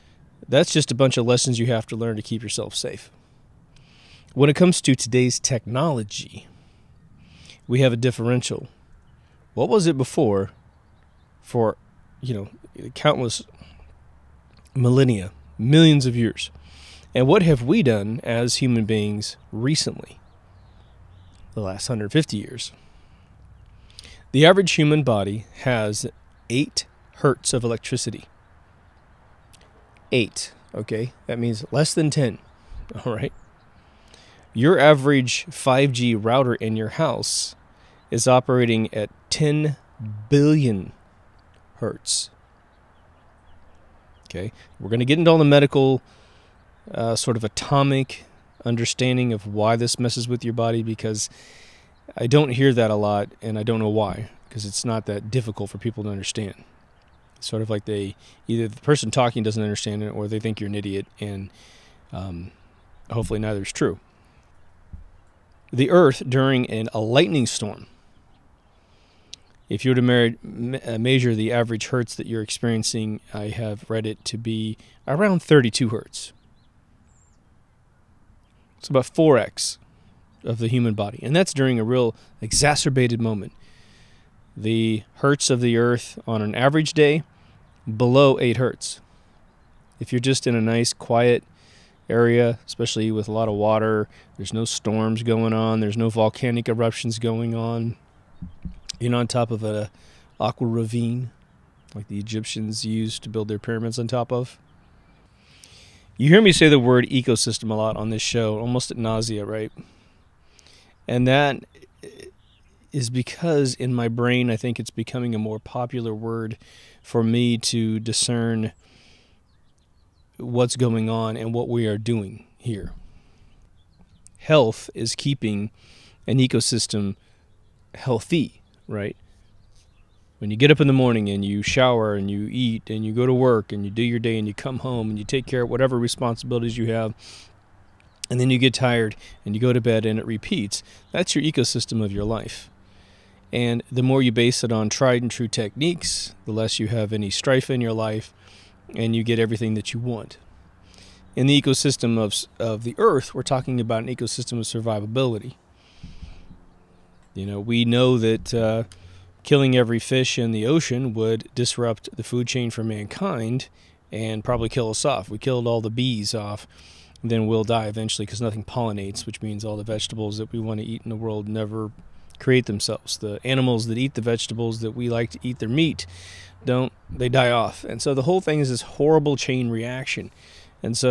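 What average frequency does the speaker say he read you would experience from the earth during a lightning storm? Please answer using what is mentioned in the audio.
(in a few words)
32 hertz.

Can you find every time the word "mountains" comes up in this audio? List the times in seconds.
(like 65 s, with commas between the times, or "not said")
not said.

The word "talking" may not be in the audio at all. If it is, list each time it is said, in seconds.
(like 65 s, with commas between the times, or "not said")
59 s, 153 s.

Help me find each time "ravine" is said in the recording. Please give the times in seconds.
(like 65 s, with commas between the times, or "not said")
100 s.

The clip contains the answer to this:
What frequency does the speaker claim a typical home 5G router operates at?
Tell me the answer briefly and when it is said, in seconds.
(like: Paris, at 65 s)
10 billion hertz, at 39 s.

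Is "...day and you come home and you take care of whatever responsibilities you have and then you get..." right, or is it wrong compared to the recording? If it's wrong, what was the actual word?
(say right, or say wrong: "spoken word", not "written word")
right.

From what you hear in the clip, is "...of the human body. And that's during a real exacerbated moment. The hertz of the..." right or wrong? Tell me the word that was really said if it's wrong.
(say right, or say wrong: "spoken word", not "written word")
right.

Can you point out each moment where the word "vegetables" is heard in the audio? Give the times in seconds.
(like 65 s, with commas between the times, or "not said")
169 s, 174 s.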